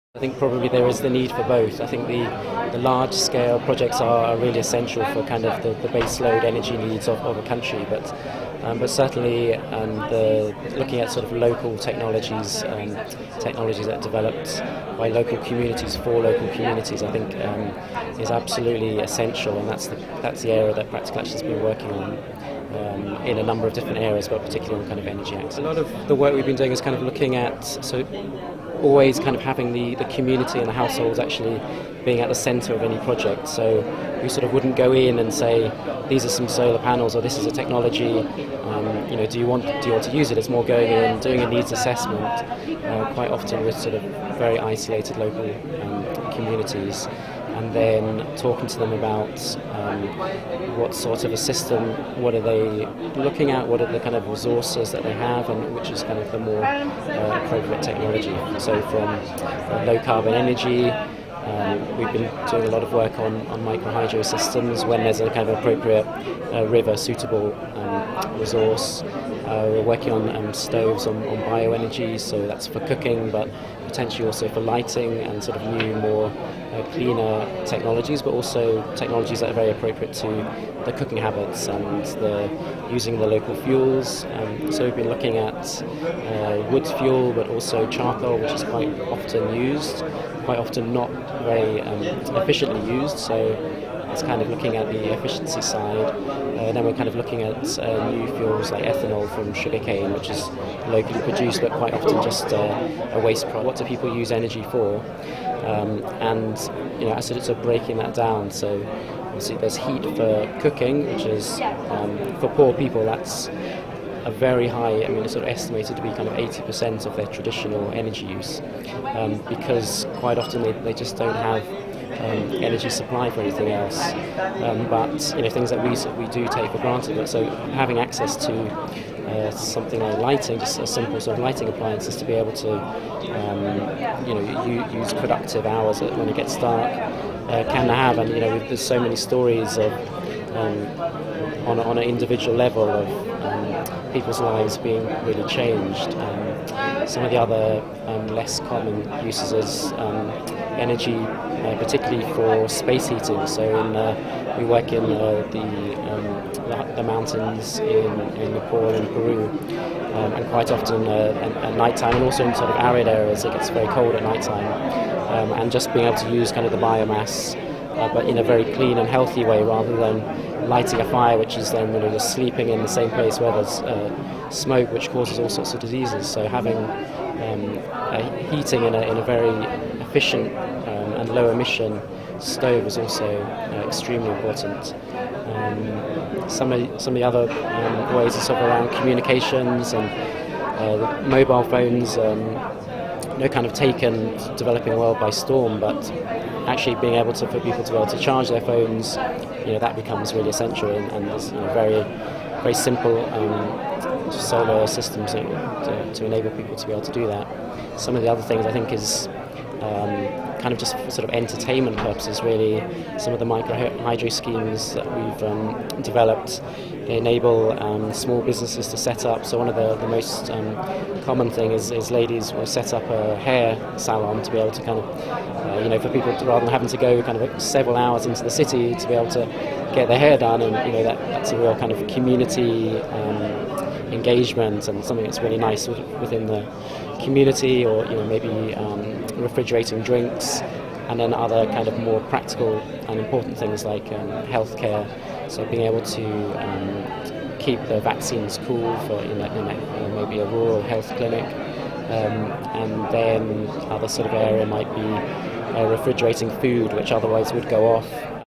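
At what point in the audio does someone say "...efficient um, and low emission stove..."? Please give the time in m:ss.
3:00.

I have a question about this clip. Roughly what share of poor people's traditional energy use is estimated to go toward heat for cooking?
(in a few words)
80%.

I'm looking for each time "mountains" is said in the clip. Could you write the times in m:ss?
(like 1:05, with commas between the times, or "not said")
2:37.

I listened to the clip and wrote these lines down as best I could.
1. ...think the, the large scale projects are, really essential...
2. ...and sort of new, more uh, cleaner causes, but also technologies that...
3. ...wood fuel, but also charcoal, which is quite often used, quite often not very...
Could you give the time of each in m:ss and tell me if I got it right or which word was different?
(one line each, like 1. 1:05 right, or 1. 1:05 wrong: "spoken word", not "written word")
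1. 0:01 right
2. 1:15 wrong: "technologies", not "causes"
3. 1:26 right.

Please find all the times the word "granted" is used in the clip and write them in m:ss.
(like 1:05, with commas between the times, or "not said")
2:06.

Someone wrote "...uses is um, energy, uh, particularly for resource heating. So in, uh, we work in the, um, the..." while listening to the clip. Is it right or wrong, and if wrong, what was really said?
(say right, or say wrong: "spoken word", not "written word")
wrong: "space", not "resource".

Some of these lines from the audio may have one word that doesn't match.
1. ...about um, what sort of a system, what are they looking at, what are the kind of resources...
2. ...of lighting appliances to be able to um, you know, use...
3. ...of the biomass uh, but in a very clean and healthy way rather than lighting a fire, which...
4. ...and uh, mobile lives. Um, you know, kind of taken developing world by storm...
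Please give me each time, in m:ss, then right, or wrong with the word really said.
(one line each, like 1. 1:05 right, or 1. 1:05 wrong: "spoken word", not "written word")
1. 0:48 right
2. 2:11 right
3. 2:46 right
4. 3:09 wrong: "phones", not "lives".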